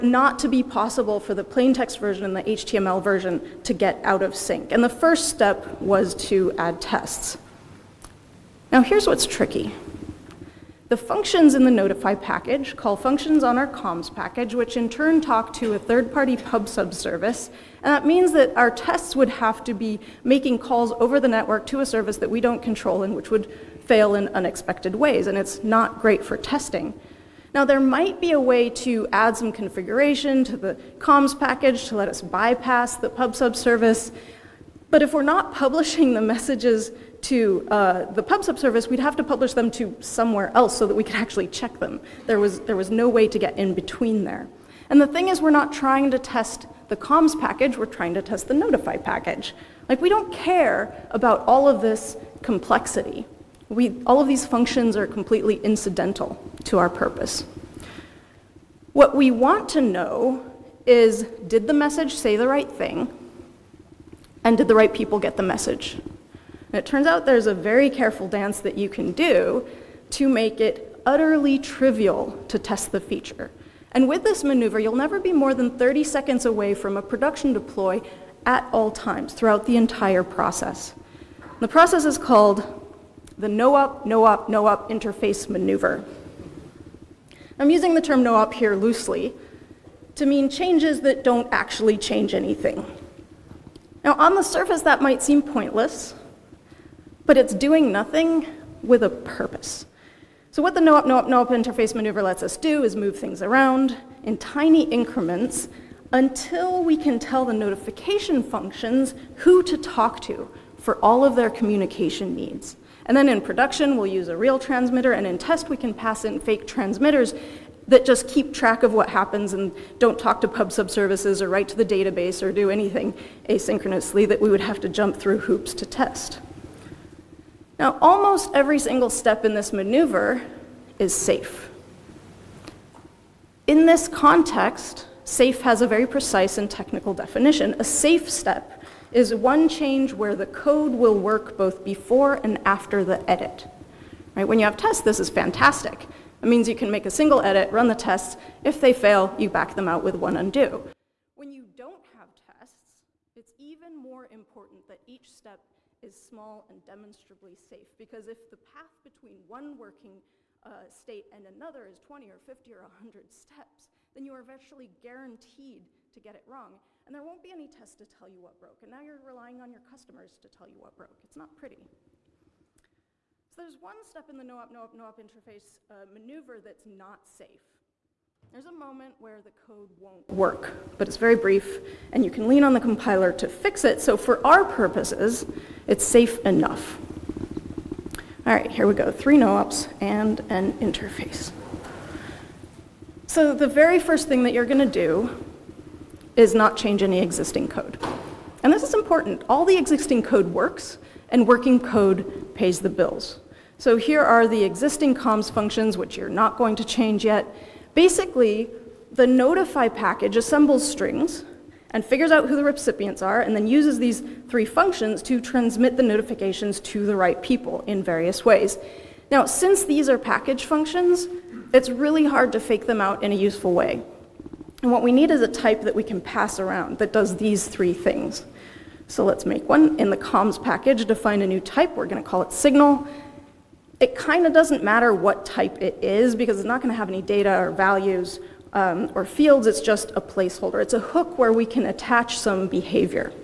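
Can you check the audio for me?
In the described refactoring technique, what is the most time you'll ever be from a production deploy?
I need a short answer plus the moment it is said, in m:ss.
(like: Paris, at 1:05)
30 seconds, at 1:15.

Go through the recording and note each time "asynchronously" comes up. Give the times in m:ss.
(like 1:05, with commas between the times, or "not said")
2:03.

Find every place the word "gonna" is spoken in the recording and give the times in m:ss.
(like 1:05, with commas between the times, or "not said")
3:14.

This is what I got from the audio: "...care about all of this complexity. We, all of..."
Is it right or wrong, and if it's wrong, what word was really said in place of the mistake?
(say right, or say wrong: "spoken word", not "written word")
right.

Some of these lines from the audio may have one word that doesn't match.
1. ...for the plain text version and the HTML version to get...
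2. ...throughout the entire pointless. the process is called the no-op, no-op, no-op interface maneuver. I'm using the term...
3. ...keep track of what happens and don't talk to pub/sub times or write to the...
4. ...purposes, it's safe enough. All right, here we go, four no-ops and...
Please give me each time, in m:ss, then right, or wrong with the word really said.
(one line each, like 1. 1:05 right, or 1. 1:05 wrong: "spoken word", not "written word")
1. 0:01 right
2. 1:19 wrong: "process", not "pointless"
3. 1:58 wrong: "services", not "times"
4. 3:04 wrong: "three", not "four".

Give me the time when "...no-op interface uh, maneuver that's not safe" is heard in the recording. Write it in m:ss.
2:54.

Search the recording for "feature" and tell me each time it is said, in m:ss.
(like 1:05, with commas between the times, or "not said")
1:12.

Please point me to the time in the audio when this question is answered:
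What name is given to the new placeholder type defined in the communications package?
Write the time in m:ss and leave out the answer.
3:52.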